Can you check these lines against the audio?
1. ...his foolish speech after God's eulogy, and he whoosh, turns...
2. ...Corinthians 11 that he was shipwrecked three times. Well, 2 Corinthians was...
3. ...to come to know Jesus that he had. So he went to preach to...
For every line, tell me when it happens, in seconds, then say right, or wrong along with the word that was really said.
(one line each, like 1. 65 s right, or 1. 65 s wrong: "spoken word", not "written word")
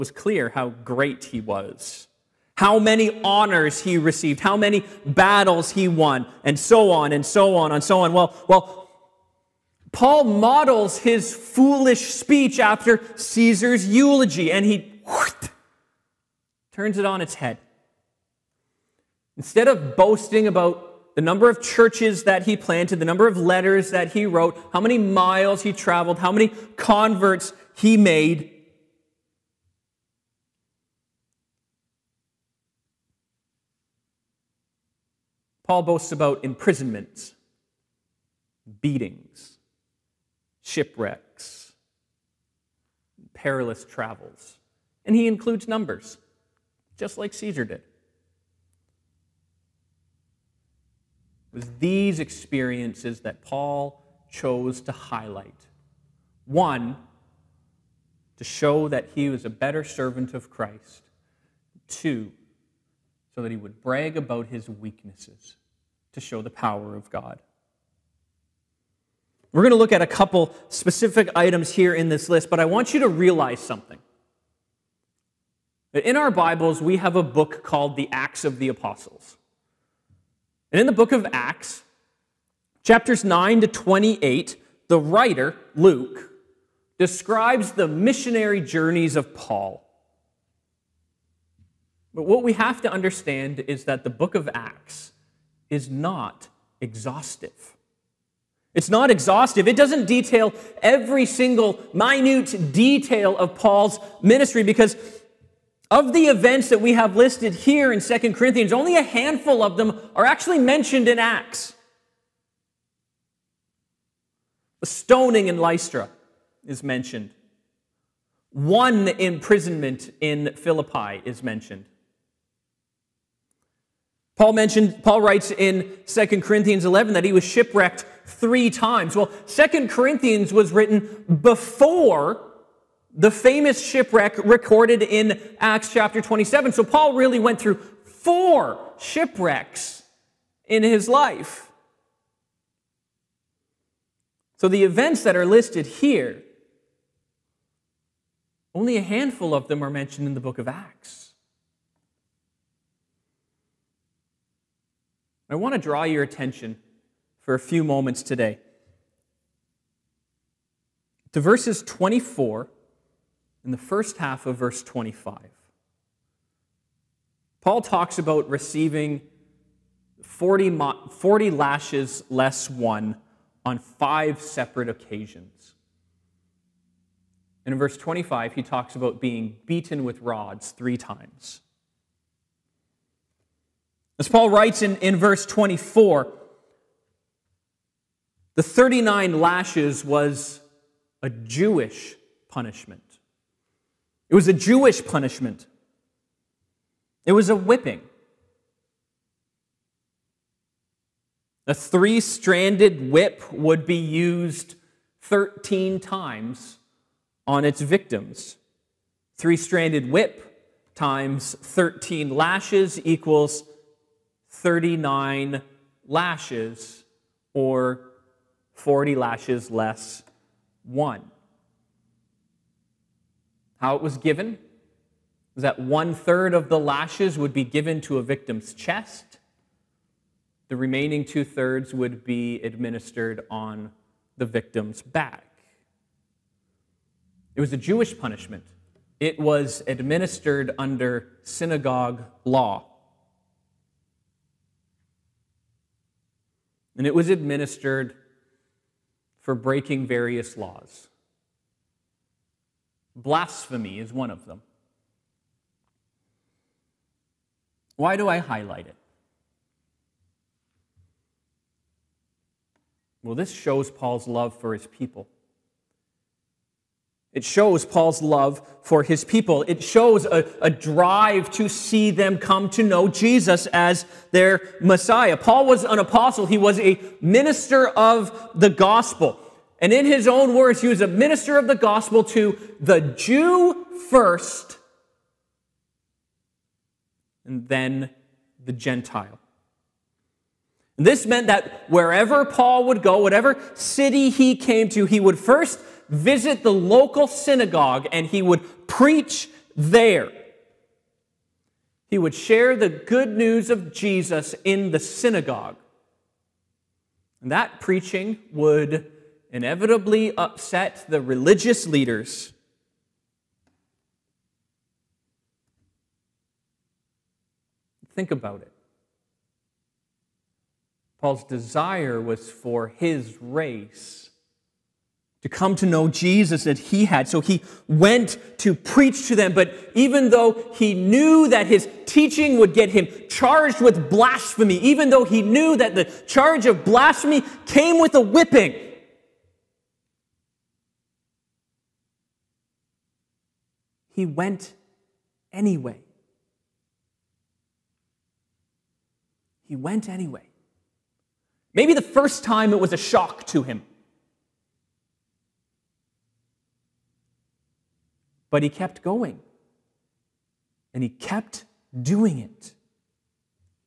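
1. 10 s wrong: "Caesar", not "God"
2. 126 s right
3. 325 s right.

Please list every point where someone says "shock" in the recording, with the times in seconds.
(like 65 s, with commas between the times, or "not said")
352 s.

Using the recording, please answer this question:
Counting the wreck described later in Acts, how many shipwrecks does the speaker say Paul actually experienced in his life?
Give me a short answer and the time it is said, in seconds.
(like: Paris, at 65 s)
4, at 138 s.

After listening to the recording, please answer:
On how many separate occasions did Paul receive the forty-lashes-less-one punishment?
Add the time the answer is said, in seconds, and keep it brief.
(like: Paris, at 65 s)
5, at 173 s.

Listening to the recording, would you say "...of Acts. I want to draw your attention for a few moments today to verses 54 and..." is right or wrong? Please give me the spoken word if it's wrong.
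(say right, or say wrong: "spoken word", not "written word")
wrong: "24", not "54".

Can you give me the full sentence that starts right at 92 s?
But what we have to understand is that the book of Acts is not exhaustive.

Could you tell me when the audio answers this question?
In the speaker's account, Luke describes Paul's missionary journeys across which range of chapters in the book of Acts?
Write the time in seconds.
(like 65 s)
82 s.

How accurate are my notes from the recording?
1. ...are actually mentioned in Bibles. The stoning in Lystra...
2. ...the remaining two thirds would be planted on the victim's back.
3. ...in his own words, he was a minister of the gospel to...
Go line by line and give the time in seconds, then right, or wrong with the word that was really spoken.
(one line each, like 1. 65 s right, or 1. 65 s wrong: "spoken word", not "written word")
1. 110 s wrong: "Acts", not "Bibles"
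2. 230 s wrong: "administered", not "planted"
3. 279 s right.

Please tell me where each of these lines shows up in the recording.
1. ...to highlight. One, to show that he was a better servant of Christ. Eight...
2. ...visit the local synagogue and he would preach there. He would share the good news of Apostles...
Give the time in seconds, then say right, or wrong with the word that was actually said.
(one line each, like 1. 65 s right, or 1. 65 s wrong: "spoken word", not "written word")
1. 54 s wrong: "Two", not "Eight"
2. 296 s wrong: "Jesus", not "Apostles".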